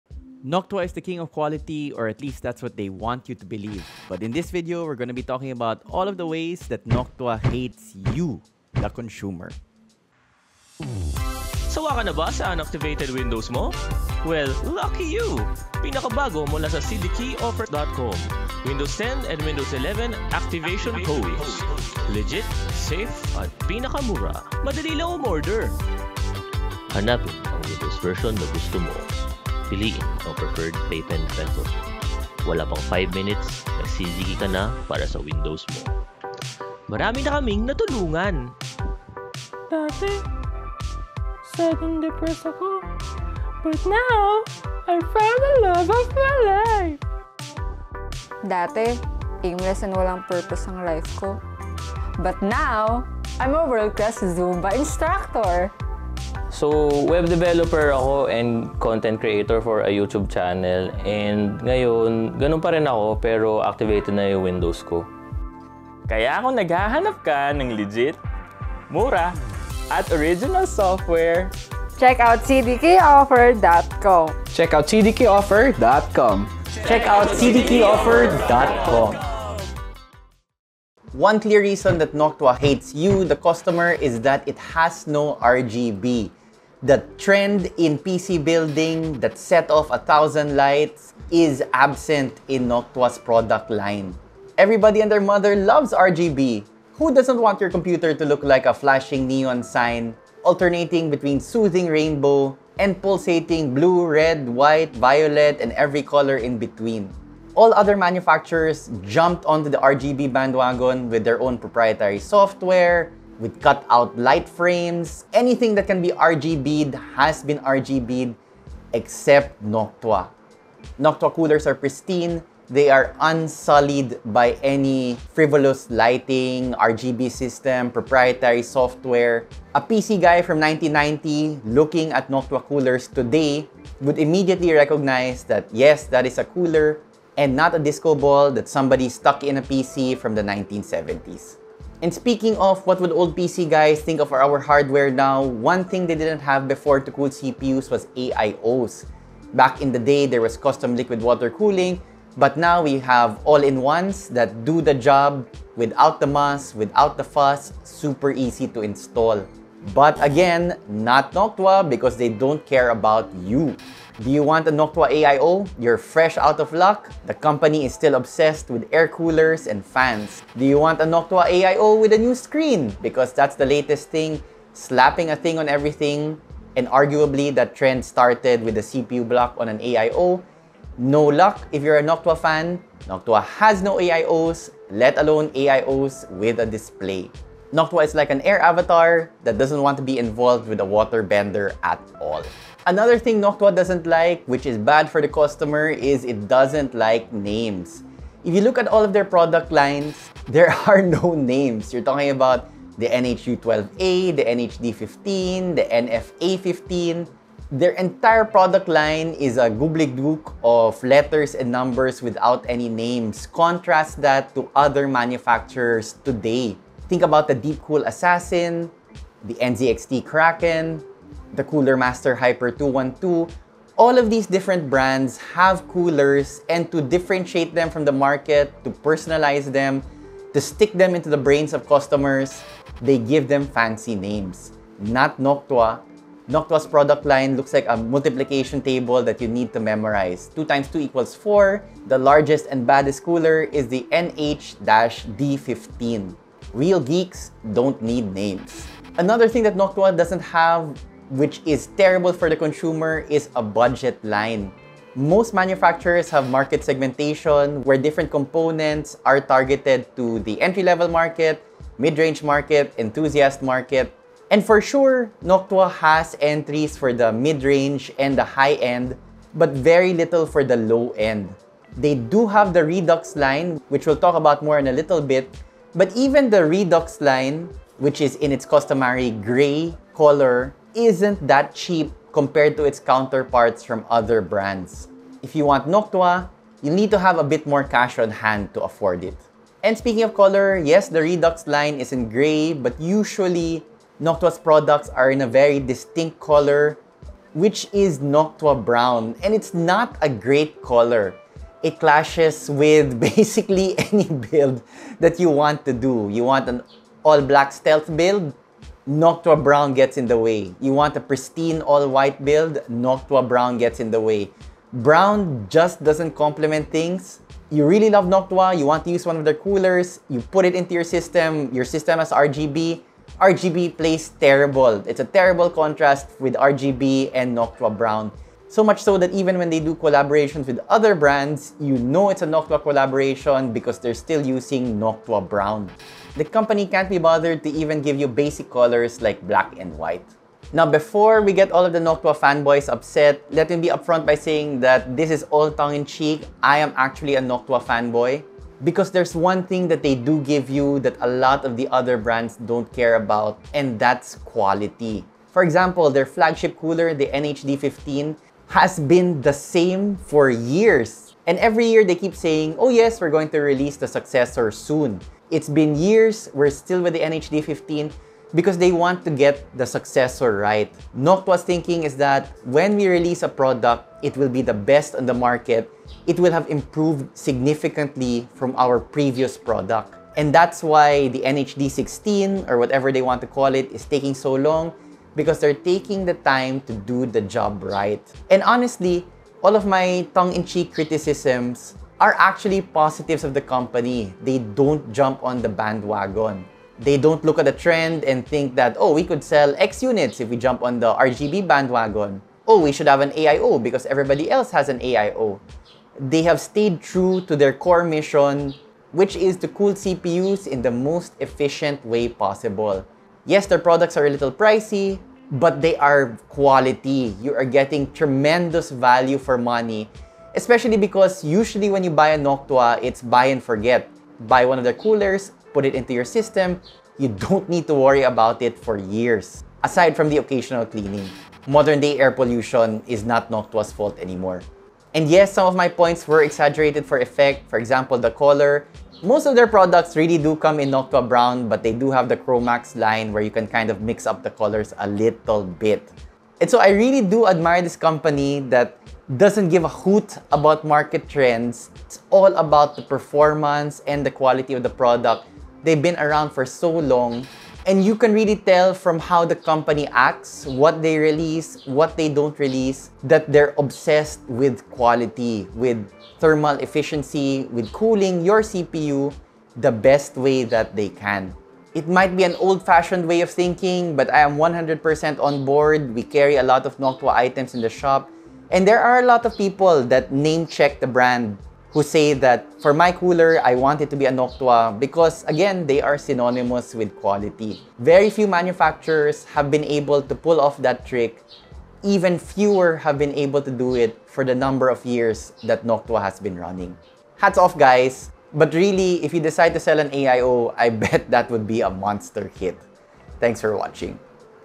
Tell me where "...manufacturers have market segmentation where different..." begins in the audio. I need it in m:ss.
4:15.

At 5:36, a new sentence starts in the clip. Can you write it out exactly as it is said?
The company can't be bothered to even give you basic colors like black and white.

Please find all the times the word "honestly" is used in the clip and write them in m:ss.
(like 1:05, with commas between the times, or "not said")
6:28.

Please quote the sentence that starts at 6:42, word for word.
Oh, we should have an AIO because everybody else has an AIO.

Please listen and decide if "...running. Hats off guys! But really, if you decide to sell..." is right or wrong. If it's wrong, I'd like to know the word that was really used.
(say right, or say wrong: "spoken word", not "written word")
right.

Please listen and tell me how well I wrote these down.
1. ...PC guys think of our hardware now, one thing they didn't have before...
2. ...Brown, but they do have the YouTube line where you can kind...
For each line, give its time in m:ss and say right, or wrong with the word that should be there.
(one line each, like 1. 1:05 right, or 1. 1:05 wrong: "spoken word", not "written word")
1. 2:23 right
2. 7:21 wrong: "Chromax", not "YouTube".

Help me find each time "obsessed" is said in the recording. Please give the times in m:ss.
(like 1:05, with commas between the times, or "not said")
2:48, 7:43.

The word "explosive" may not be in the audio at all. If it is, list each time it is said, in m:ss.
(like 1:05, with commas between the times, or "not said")
not said.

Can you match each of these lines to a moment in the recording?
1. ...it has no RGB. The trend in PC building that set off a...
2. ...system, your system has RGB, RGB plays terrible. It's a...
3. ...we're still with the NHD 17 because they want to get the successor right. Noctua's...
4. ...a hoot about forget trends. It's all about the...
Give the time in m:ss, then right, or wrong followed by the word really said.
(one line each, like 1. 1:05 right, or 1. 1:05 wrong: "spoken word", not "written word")
1. 1:24 right
2. 5:21 right
3. 6:06 wrong: "15", not "17"
4. 7:29 wrong: "market", not "forget".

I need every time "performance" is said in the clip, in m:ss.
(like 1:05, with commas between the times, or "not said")
7:33.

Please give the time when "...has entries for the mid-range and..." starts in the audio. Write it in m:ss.
4:25.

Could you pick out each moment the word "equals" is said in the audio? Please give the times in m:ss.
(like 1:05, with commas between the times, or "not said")
4:01.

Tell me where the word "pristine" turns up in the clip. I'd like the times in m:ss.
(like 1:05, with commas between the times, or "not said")
2:01, 5:11.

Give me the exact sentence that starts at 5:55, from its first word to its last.
For example, their flagship cooler, the NHD15, has been the same for years.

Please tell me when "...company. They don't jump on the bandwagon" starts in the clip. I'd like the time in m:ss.
6:33.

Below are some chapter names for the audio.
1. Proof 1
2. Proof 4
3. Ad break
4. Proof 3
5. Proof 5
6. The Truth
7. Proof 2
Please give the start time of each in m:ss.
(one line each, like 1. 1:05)
1. 1:20
2. 4:10
3. 0:10
4. 3:13
5. 4:49
6. 5:41
7. 2:22.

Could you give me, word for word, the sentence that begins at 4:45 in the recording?
If you want Noctua, you need to have a bit more cash on hand to afford it.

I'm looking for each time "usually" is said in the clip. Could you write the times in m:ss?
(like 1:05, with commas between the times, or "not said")
4:52, 7:01.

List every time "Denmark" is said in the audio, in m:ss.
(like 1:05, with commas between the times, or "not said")
not said.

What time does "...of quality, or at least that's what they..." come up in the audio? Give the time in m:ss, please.
0:01.